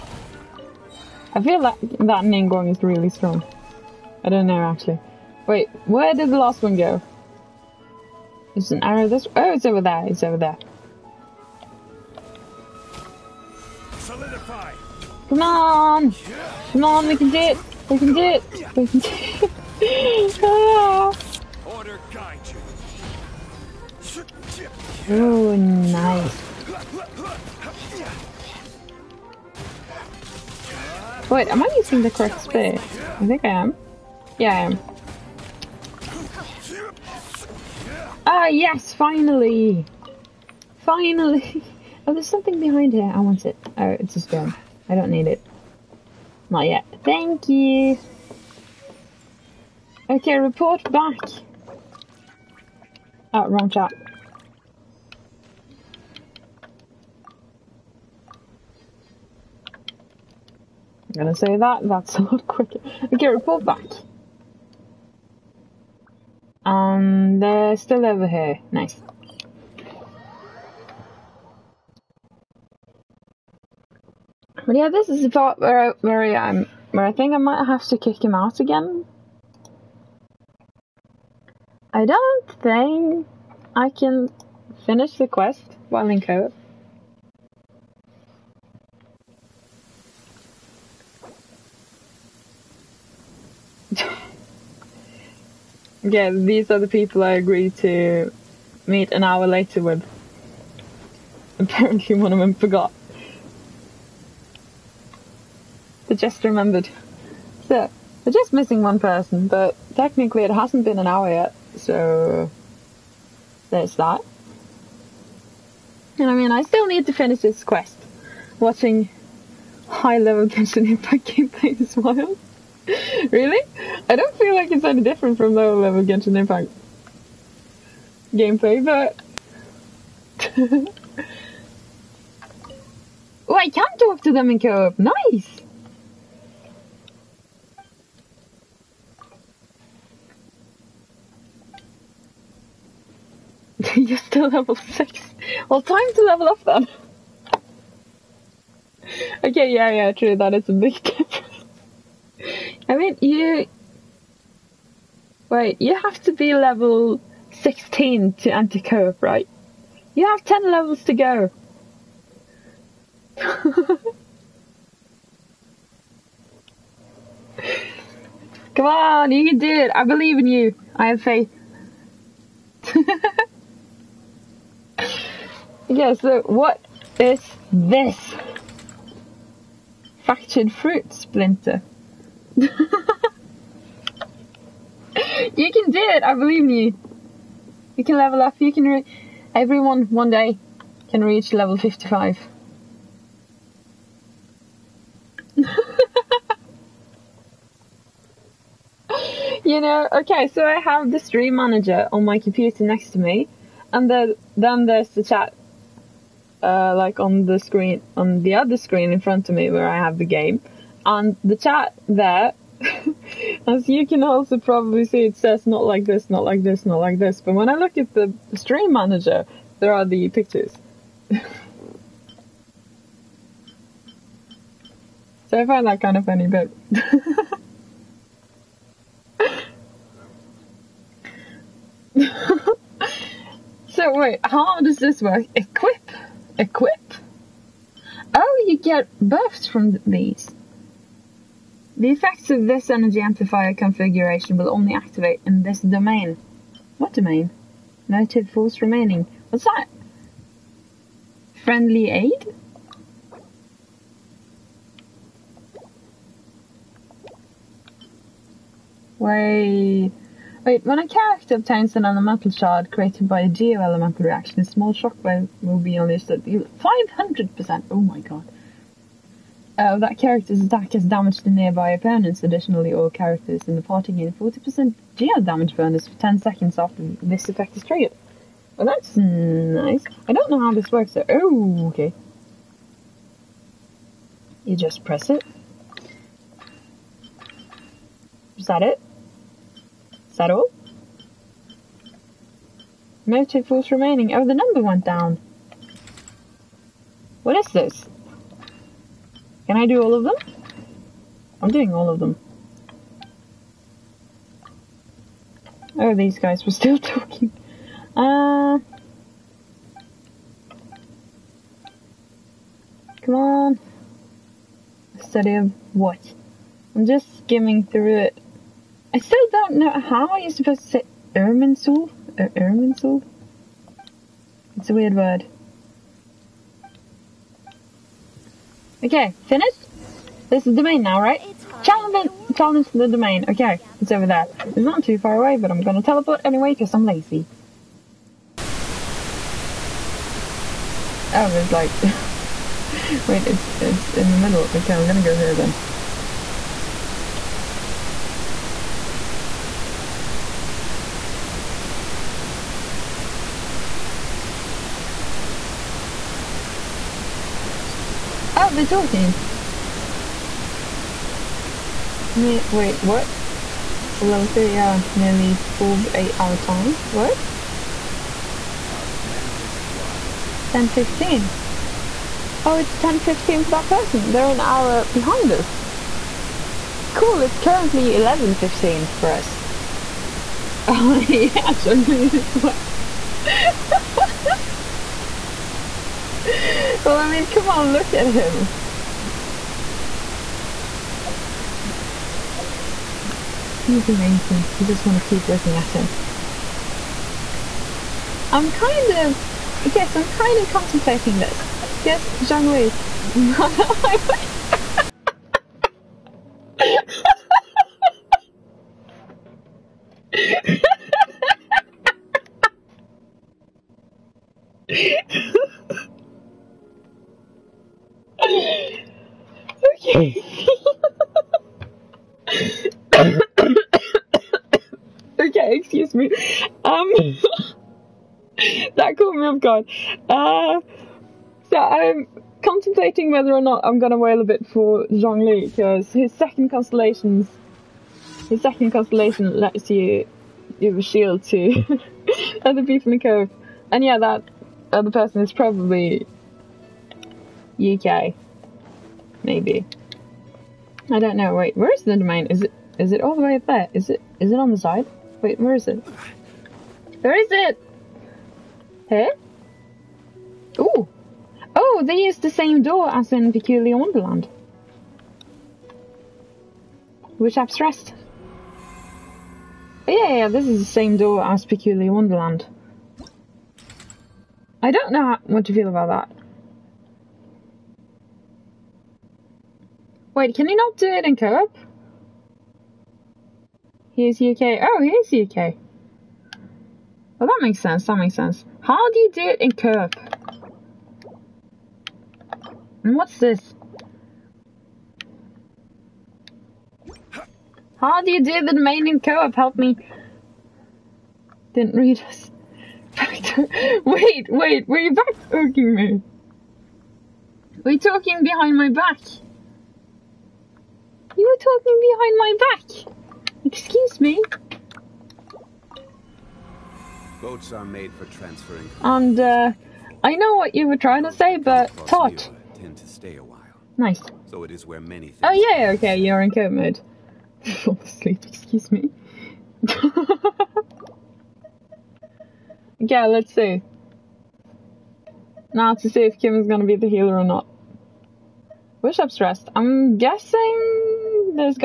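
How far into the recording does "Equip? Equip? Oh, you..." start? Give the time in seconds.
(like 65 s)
235 s.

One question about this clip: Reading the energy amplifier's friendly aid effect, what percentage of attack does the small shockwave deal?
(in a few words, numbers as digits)
500%.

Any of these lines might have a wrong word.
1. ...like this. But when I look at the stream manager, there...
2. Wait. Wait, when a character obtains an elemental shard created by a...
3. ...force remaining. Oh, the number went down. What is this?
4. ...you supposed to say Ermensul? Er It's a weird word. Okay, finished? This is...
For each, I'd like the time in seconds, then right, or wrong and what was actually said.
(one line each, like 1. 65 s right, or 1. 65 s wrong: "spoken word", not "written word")
1. 216 s right
2. 259 s right
3. 293 s right
4. 320 s right.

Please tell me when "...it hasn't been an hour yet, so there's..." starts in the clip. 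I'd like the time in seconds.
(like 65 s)
110 s.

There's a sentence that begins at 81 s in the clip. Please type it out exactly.
I don't think I can finish the quest while in co-op.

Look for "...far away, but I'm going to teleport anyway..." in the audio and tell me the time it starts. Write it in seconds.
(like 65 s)
335 s.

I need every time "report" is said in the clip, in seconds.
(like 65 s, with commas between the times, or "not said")
50 s, 63 s.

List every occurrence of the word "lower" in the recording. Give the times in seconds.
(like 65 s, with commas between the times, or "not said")
125 s.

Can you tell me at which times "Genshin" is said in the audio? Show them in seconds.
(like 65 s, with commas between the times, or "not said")
120 s, 126 s.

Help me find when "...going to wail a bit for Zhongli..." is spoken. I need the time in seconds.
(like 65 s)
433 s.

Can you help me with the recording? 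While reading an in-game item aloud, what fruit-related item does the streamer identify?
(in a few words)
Fractured fruit splinter.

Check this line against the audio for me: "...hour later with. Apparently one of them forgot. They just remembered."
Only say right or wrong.
right.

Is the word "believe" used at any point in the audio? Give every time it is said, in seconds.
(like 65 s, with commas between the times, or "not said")
170 s, 186 s.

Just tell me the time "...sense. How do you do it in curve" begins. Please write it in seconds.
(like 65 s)
488 s.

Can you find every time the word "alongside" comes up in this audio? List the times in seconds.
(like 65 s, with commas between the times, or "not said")
not said.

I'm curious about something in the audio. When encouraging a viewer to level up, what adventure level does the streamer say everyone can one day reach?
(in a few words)
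55.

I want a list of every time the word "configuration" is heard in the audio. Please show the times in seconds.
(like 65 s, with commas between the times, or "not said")
243 s.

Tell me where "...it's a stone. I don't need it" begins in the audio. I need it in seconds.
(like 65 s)
43 s.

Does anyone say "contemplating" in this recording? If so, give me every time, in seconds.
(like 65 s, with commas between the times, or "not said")
400 s, 432 s.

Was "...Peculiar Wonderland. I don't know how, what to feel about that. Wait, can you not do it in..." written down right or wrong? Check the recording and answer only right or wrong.
right.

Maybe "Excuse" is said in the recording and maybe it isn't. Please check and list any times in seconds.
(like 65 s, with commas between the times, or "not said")
513 s, 528 s.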